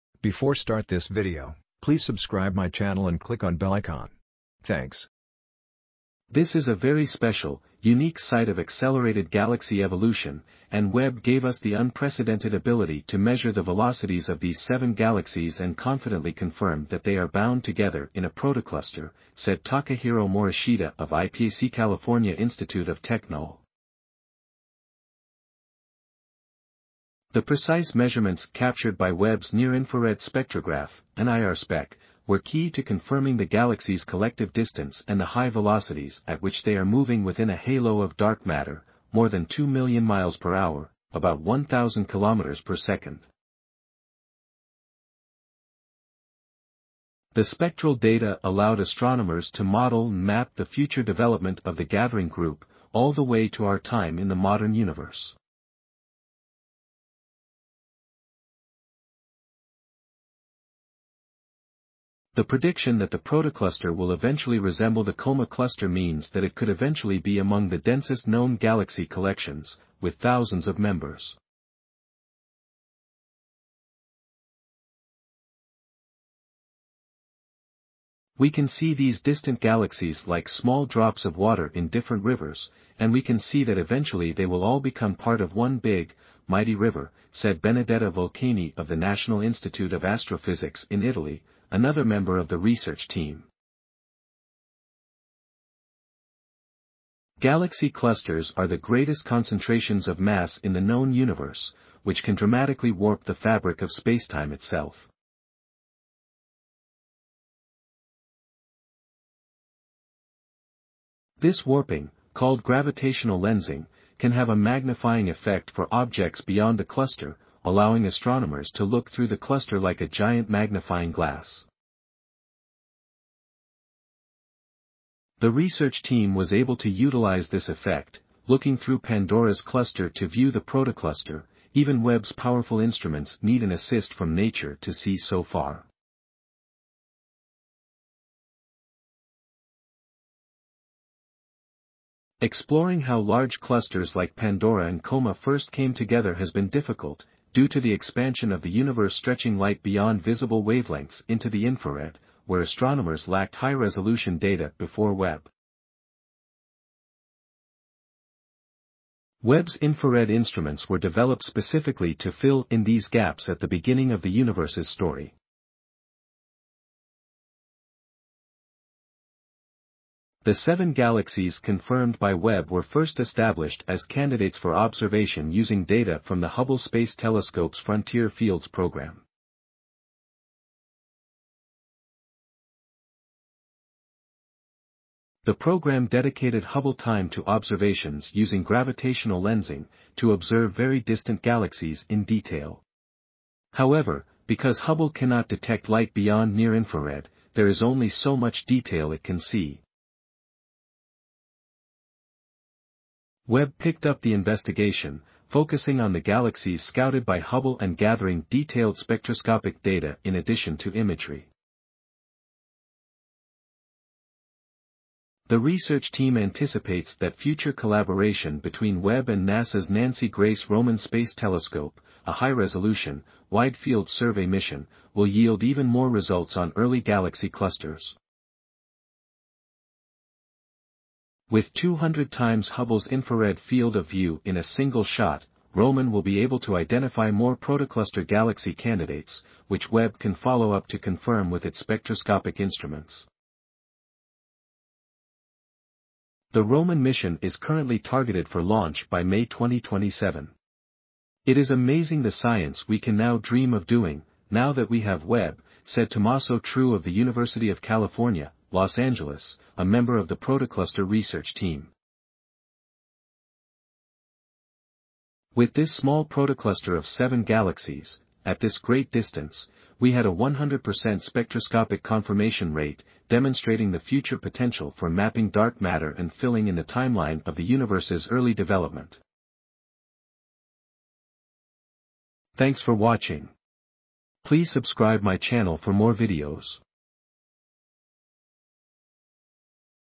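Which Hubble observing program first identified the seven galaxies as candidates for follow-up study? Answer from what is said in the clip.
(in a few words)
Frontier Fields.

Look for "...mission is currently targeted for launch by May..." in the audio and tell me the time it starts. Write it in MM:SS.
04:07.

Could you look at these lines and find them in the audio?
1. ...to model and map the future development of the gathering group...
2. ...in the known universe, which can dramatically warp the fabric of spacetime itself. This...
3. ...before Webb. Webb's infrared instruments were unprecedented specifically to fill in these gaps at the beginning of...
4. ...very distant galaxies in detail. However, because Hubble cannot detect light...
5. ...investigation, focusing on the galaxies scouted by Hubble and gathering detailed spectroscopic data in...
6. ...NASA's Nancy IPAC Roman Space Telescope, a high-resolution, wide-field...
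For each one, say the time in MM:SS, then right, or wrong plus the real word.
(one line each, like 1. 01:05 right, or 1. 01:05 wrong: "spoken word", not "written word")
1. 00:49 right
2. 01:40 right
3. 02:34 wrong: "developed", not "unprecedented"
4. 03:10 right
5. 03:24 right
6. 03:39 wrong: "Grace", not "IPAC".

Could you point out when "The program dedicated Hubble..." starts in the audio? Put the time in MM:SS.
03:05.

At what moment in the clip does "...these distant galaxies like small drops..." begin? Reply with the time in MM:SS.
01:18.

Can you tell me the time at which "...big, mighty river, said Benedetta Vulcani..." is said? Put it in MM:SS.
01:25.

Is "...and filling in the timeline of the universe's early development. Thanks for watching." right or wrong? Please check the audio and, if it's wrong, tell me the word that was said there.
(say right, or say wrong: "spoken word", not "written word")
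right.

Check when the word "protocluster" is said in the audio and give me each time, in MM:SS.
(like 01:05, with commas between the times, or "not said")
00:18, 01:03, 02:10, 03:57, 04:20, 04:26.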